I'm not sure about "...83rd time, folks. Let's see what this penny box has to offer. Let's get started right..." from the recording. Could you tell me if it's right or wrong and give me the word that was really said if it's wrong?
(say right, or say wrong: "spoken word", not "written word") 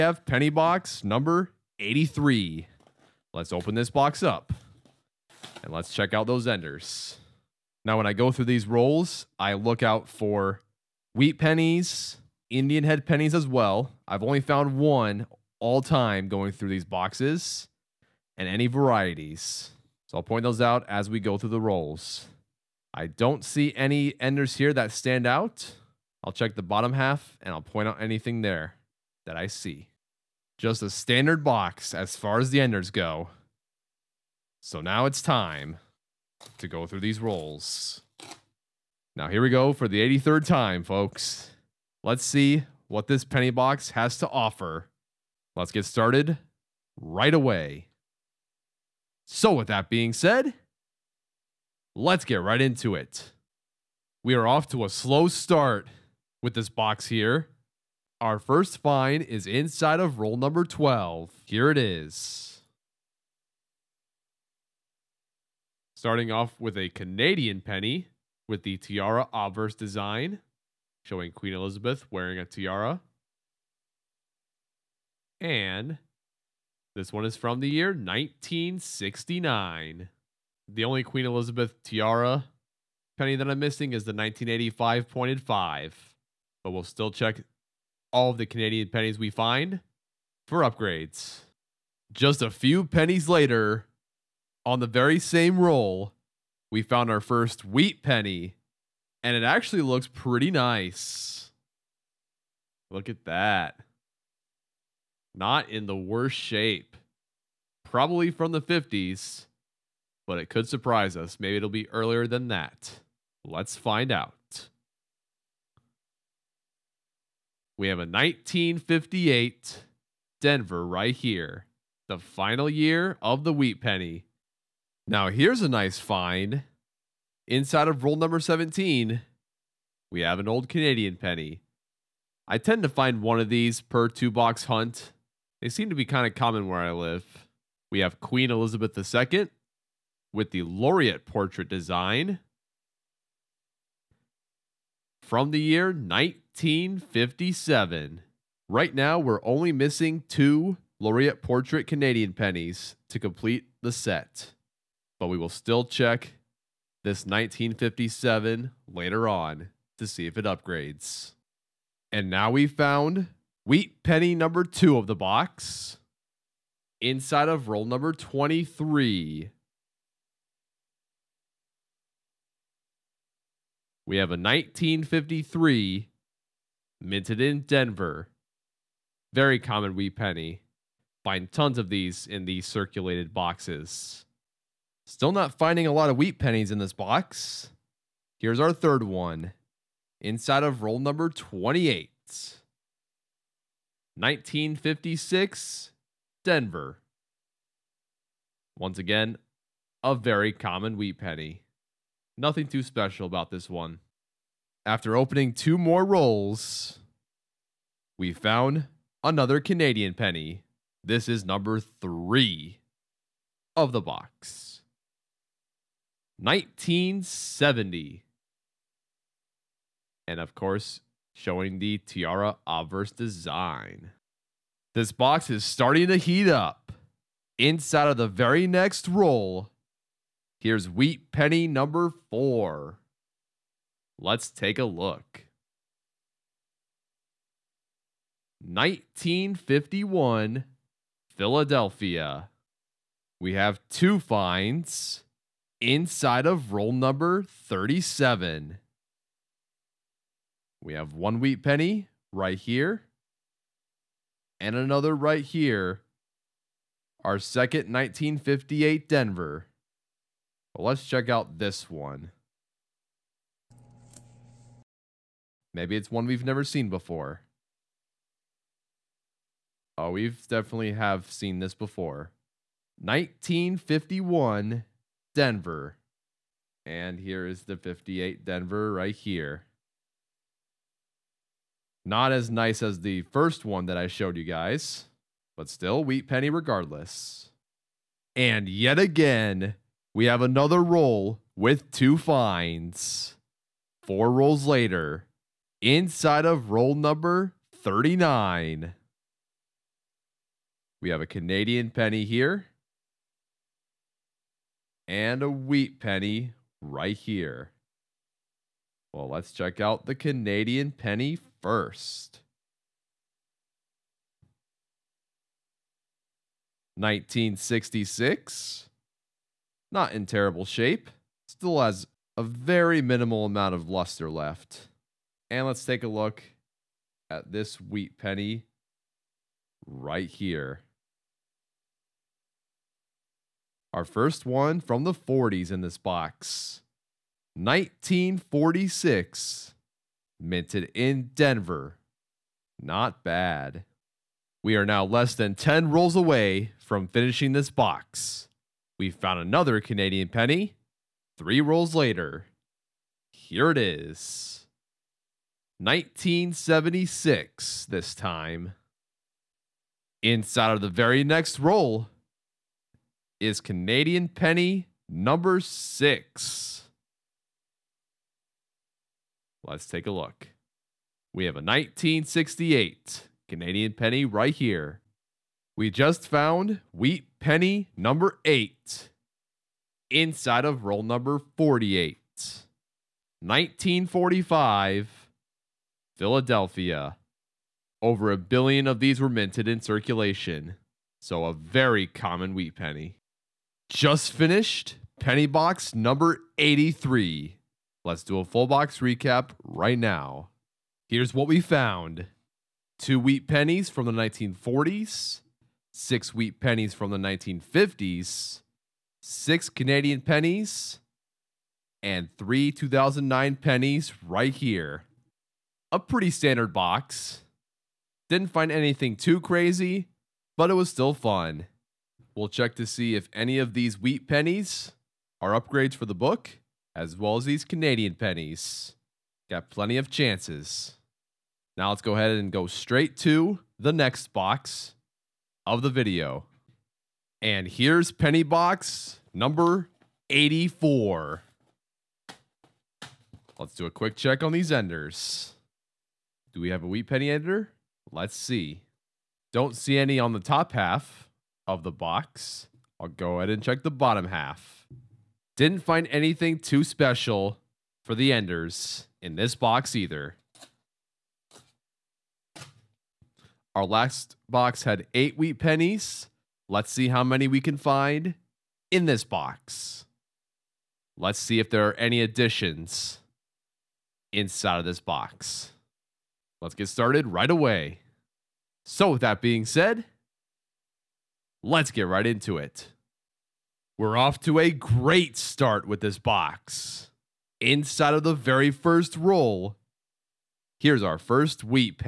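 right.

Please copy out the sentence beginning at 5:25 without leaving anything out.
And let's take a look at this wheat penny right here.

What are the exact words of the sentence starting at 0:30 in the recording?
Just a standard box as far as the enders go.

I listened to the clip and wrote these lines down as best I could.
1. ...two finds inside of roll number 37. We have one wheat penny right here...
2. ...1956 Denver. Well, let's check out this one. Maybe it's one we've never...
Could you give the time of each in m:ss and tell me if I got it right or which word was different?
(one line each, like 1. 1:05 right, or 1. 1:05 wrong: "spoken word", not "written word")
1. 4:03 right
2. 4:17 wrong: "1958", not "1956".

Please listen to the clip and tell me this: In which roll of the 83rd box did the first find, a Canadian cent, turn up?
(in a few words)
12.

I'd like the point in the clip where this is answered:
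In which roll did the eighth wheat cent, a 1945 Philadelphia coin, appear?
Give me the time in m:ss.
6:21.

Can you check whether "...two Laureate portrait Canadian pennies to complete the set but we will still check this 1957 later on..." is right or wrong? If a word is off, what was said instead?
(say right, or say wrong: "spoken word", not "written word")
right.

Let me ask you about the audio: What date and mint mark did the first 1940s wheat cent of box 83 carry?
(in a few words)
1946 Denver.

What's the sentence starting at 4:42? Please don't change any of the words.
Not as nice as the first one that I showed you guys, but still wheat penny regardless.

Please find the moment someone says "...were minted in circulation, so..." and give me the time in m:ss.
6:29.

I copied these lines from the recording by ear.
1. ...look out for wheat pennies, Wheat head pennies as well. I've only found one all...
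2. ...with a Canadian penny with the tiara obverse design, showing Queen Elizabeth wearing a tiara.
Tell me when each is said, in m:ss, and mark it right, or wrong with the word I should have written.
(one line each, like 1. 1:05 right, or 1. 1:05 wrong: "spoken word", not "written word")
1. 0:09 wrong: "Indian", not "Wheat"
2. 1:06 right.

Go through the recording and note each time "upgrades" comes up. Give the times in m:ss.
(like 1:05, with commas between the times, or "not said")
1:30, 2:40, 7:05.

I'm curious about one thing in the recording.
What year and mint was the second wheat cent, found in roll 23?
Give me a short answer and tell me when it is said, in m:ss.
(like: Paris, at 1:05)
1953 Denver, at 2:54.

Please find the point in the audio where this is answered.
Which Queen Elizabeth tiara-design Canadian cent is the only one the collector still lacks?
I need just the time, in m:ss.
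1:24.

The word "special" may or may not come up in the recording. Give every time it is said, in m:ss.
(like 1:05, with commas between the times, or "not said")
3:22, 7:36.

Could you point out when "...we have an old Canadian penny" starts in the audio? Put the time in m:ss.
2:10.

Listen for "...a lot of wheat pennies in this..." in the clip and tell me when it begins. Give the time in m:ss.
3:05.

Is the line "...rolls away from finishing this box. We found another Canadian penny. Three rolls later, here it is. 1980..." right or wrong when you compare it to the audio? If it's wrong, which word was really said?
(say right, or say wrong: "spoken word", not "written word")
wrong: "1976", not "1980".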